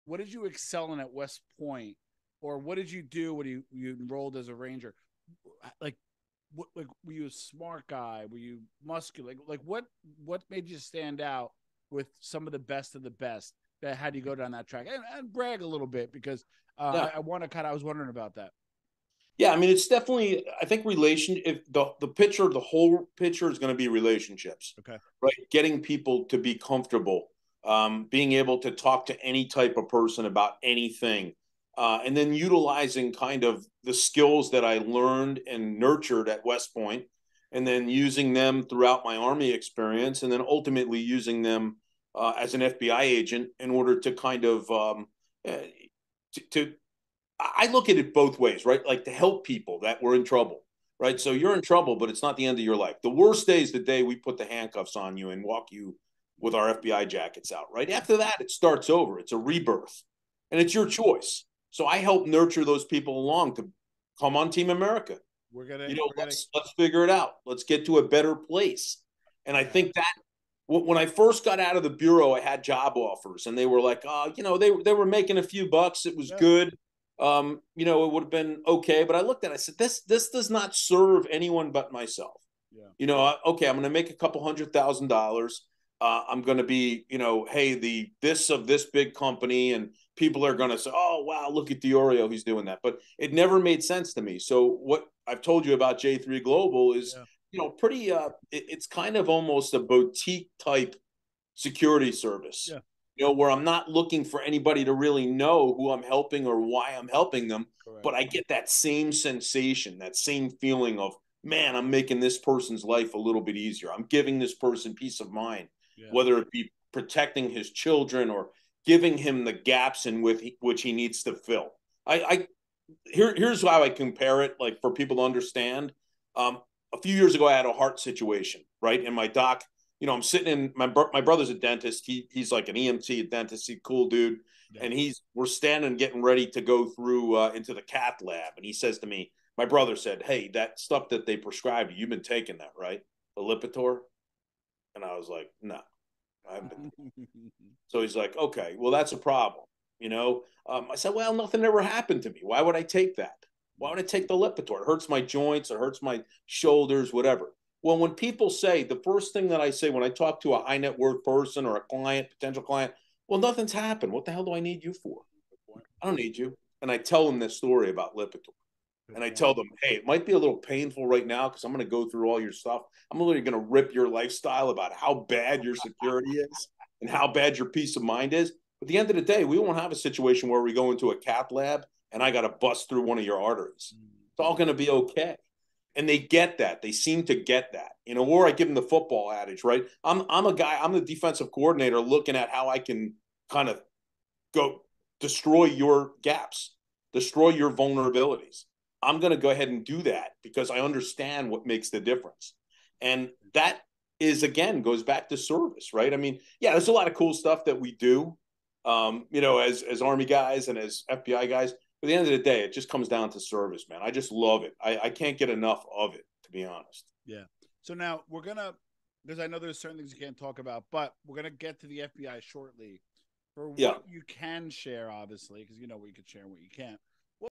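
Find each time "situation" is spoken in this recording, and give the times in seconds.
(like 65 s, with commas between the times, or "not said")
127 s, 179 s.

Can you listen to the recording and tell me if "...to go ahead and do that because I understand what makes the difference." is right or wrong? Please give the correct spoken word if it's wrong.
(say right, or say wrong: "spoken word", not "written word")
right.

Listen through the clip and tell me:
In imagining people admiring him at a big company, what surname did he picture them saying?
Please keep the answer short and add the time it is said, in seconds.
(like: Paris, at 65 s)
Diorio, at 91 s.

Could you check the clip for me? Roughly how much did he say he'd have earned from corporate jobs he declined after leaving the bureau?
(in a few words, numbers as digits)
a couple hundred thousand dollars.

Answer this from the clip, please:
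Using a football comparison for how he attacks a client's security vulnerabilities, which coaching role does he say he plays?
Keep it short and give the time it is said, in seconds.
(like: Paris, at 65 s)
defensive coordinator, at 191 s.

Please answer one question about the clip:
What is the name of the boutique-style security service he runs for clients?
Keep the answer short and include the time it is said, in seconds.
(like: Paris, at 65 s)
J3 Global, at 95 s.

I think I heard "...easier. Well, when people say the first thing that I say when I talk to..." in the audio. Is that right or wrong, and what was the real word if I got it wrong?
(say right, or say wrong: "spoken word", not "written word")
wrong: "whatever", not "easier".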